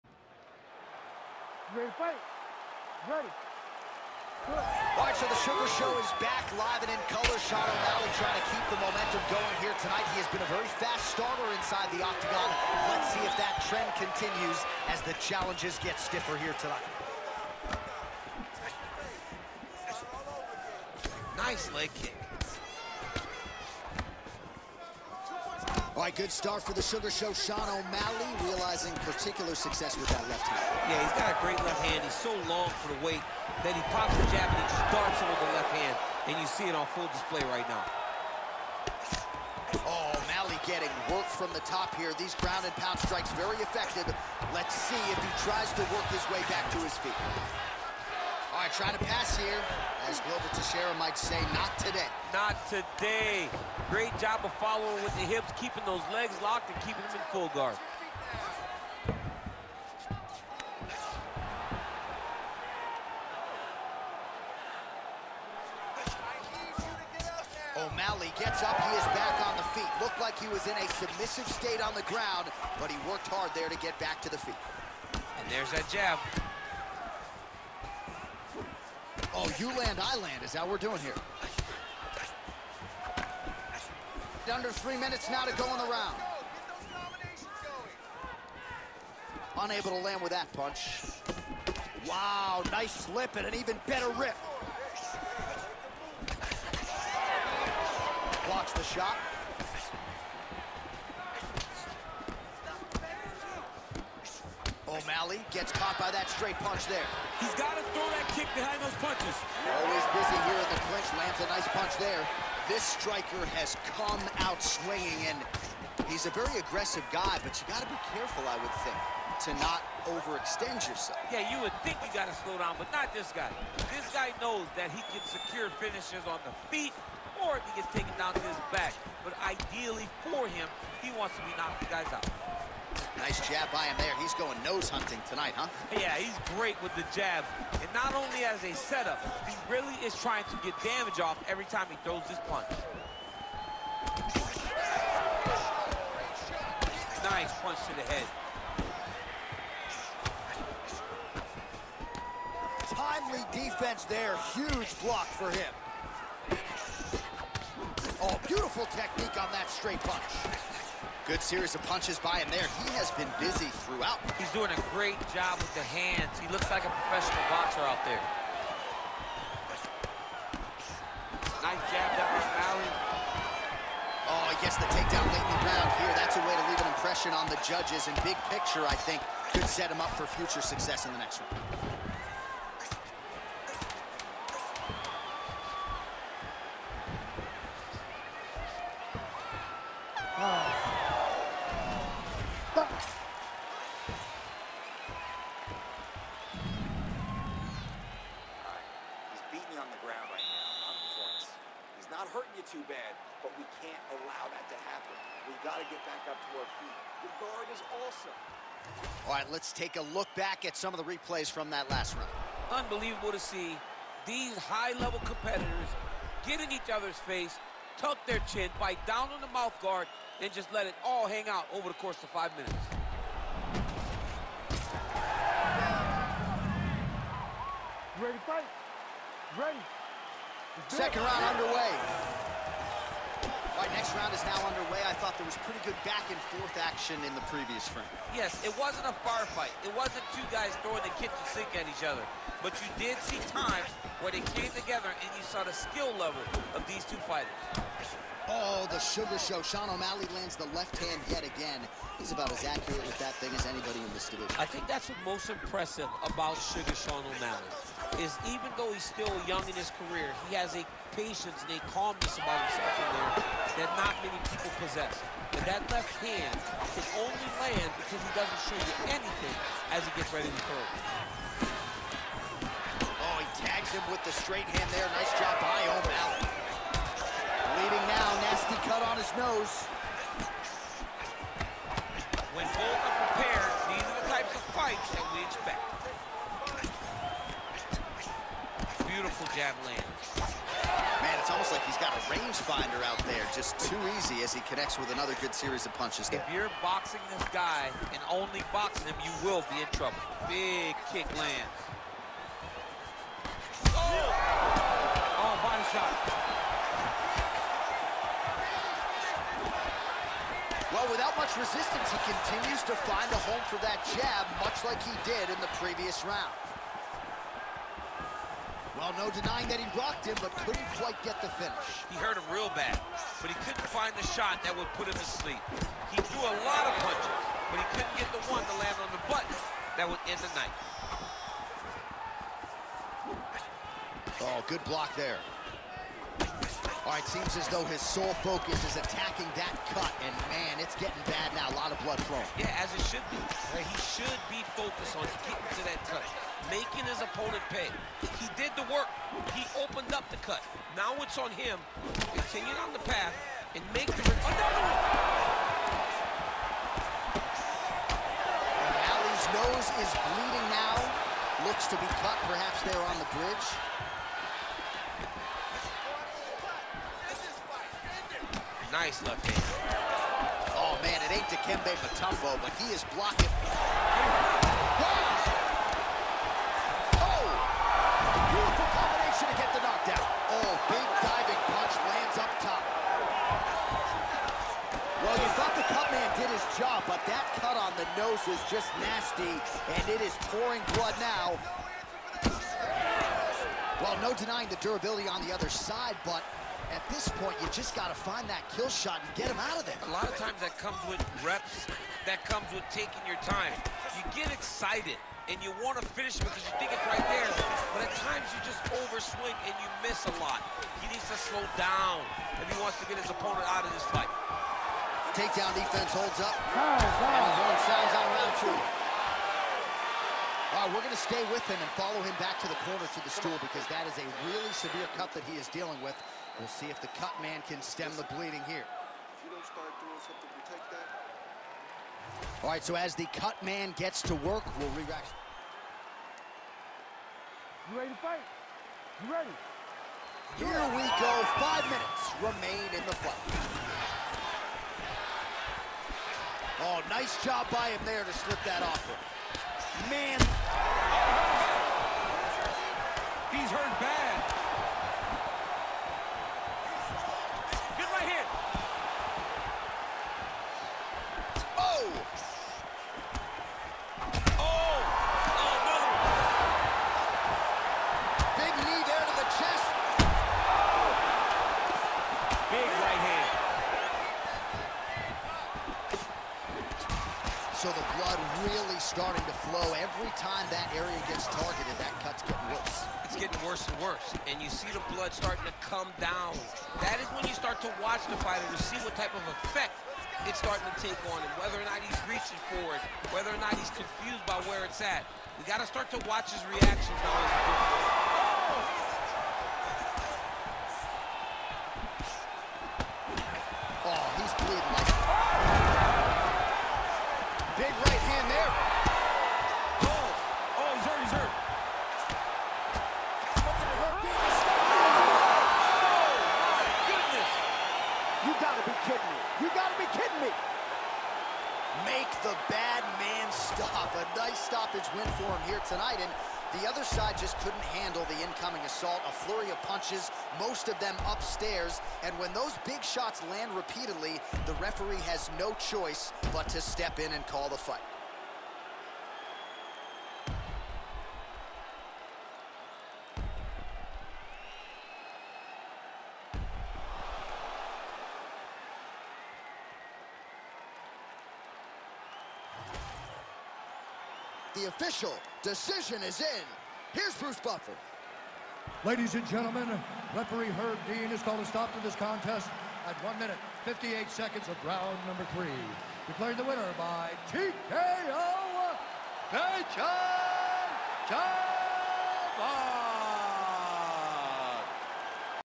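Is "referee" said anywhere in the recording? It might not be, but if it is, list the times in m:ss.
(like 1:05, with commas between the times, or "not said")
8:54, 9:20.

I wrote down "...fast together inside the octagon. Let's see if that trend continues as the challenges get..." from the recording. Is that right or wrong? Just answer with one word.
wrong.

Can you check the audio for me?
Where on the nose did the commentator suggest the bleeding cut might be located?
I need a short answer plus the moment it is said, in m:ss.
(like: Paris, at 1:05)
the bridge, at 6:03.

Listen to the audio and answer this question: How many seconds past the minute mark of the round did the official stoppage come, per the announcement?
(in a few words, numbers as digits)
58.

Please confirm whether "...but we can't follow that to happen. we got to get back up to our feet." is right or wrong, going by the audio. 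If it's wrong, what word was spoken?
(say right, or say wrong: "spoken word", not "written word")
wrong: "allow", not "follow".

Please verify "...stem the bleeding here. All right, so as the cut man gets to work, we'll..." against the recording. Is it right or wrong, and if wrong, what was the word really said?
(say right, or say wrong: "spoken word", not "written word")
right.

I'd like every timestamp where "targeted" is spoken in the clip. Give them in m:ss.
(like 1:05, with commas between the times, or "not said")
8:01.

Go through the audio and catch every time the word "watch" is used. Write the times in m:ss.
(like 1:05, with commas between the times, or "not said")
8:08, 8:16.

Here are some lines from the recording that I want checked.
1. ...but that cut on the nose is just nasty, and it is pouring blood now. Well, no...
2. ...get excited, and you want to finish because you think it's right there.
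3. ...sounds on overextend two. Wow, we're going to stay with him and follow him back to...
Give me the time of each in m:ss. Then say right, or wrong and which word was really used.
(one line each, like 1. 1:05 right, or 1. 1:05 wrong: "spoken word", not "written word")
1. 6:27 right
2. 6:44 right
3. 6:57 wrong: "round", not "overextend".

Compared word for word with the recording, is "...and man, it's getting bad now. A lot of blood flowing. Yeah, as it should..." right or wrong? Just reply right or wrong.
right.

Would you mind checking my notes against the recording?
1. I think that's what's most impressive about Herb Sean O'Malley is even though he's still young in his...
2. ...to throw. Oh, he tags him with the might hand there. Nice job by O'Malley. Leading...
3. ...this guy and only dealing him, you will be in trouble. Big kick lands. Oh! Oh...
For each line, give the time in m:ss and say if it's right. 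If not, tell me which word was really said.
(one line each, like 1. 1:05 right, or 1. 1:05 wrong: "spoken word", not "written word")
1. 4:14 wrong: "Sugar", not "Herb"
2. 4:30 wrong: "straight", not "might"
3. 4:57 wrong: "boxing", not "dealing".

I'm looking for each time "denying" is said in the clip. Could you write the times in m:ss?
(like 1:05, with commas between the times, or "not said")
5:19, 6:34.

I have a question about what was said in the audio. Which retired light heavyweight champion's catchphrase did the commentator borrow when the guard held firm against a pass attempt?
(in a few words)
Glover Teixeira.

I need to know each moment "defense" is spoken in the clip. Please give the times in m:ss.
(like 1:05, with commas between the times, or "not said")
2:33, 6:55.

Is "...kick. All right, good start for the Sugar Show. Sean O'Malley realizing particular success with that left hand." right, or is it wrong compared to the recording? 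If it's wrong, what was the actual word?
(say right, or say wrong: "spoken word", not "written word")
right.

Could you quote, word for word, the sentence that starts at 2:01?
Yeah, you would think you got to slow down, but not this guy.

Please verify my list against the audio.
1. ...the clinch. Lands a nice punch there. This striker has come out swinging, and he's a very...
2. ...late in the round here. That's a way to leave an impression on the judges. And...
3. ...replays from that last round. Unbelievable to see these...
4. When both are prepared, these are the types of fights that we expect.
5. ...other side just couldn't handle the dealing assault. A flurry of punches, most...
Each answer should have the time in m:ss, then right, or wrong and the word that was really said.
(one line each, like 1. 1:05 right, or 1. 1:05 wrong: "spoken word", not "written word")
1. 1:50 right
2. 2:55 right
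3. 3:31 right
4. 4:42 right
5. 8:46 wrong: "incoming", not "dealing".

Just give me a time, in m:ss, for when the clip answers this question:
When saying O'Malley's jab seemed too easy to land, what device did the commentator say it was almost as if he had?
4:52.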